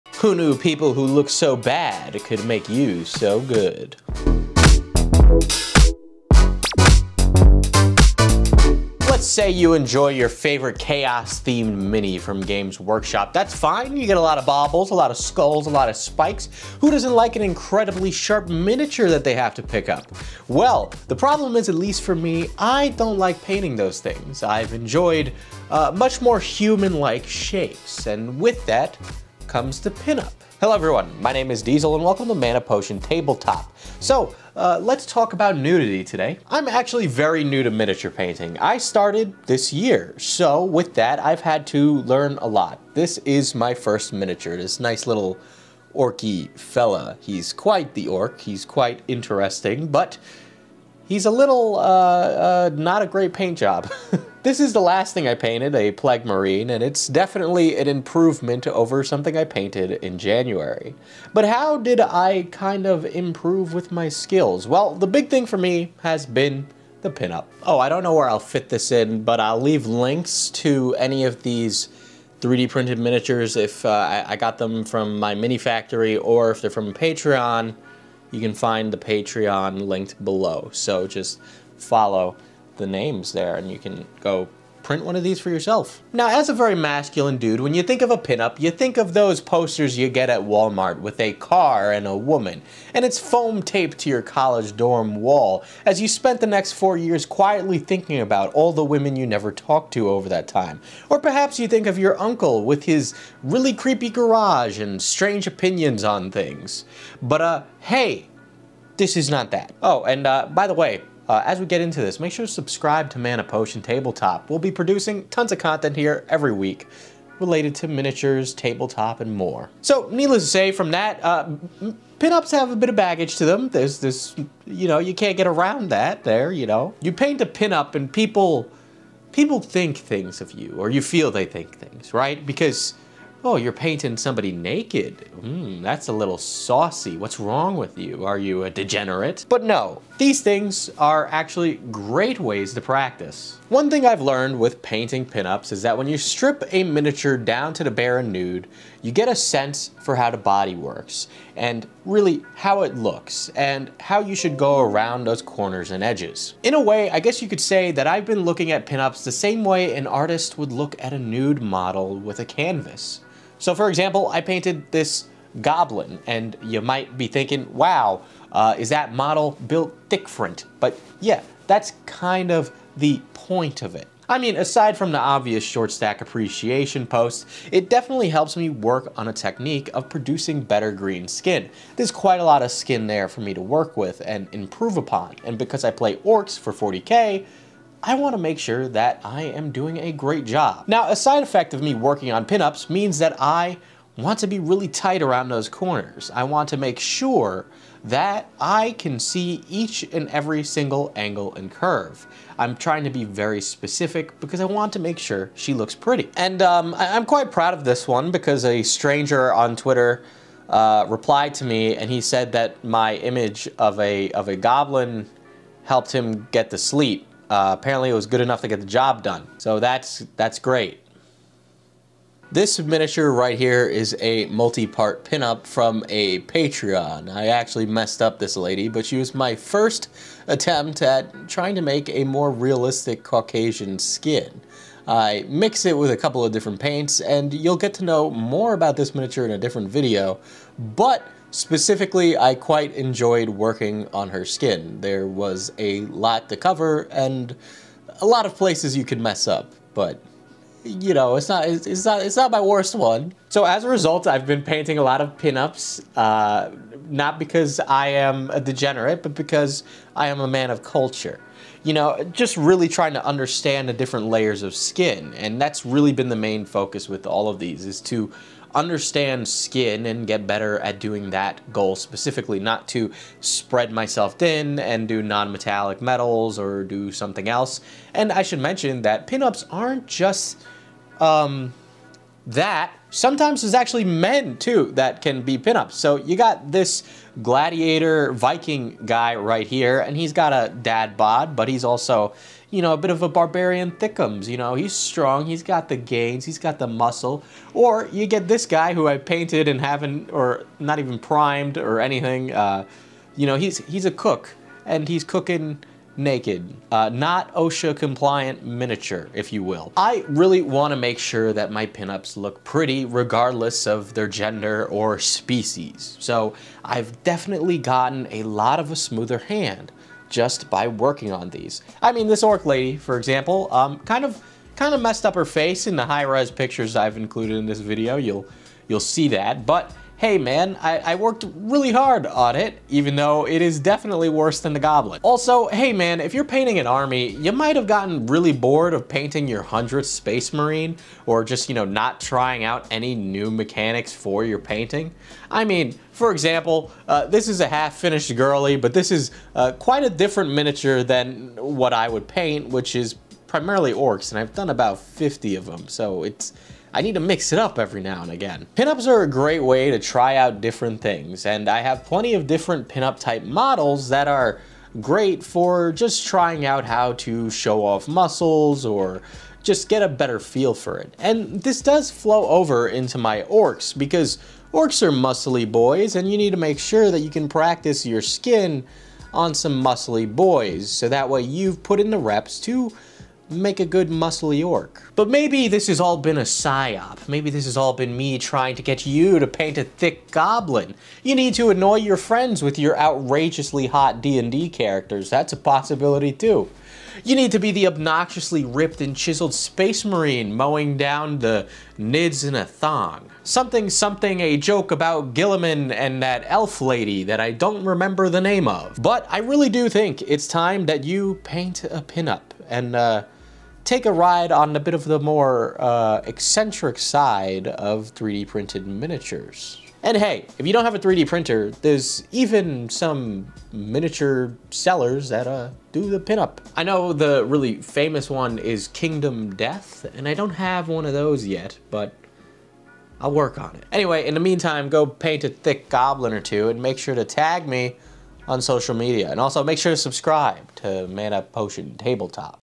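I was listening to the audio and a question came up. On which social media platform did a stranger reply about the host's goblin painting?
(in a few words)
Twitter.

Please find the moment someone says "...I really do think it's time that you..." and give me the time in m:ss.
6:49.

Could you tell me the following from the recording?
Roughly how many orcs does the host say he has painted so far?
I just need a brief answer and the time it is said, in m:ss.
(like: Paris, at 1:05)
50, at 5:54.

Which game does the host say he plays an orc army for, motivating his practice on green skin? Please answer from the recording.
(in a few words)
40k.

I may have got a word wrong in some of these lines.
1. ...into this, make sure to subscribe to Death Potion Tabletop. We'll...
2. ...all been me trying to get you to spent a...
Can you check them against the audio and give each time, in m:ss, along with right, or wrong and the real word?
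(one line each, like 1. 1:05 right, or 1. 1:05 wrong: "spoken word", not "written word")
1. 1:51 wrong: "Mana", not "Death"
2. 6:27 wrong: "paint", not "spent".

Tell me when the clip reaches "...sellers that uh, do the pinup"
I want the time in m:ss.
7:04.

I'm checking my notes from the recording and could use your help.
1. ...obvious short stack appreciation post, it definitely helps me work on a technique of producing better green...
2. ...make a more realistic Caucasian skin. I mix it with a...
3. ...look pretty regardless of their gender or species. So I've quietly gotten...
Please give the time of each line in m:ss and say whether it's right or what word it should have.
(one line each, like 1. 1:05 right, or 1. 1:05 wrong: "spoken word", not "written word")
1. 2:55 right
2. 3:51 right
3. 5:12 wrong: "definitely", not "quietly".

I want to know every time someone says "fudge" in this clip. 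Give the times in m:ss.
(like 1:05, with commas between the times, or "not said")
not said.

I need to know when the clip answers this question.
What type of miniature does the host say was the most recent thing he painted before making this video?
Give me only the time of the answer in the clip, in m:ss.
0:55.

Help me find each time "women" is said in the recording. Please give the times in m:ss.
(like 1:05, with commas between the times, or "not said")
1:38.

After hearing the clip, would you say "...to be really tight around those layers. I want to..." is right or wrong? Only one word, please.
wrong.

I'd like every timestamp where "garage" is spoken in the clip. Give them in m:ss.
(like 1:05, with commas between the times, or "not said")
1:44.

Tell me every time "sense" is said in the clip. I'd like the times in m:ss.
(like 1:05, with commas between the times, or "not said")
2:29.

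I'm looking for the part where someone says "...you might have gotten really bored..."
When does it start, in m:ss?
5:37.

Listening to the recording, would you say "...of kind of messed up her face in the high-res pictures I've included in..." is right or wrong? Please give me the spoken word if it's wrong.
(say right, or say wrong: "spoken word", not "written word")
right.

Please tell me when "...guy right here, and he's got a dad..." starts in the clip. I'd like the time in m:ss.
4:49.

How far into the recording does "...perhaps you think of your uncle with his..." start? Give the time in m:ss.
1:41.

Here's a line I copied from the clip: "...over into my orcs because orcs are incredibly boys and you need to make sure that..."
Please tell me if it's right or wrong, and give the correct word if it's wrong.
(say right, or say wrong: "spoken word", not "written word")
wrong: "muscly", not "incredibly".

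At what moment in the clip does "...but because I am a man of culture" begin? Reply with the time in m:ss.
4:19.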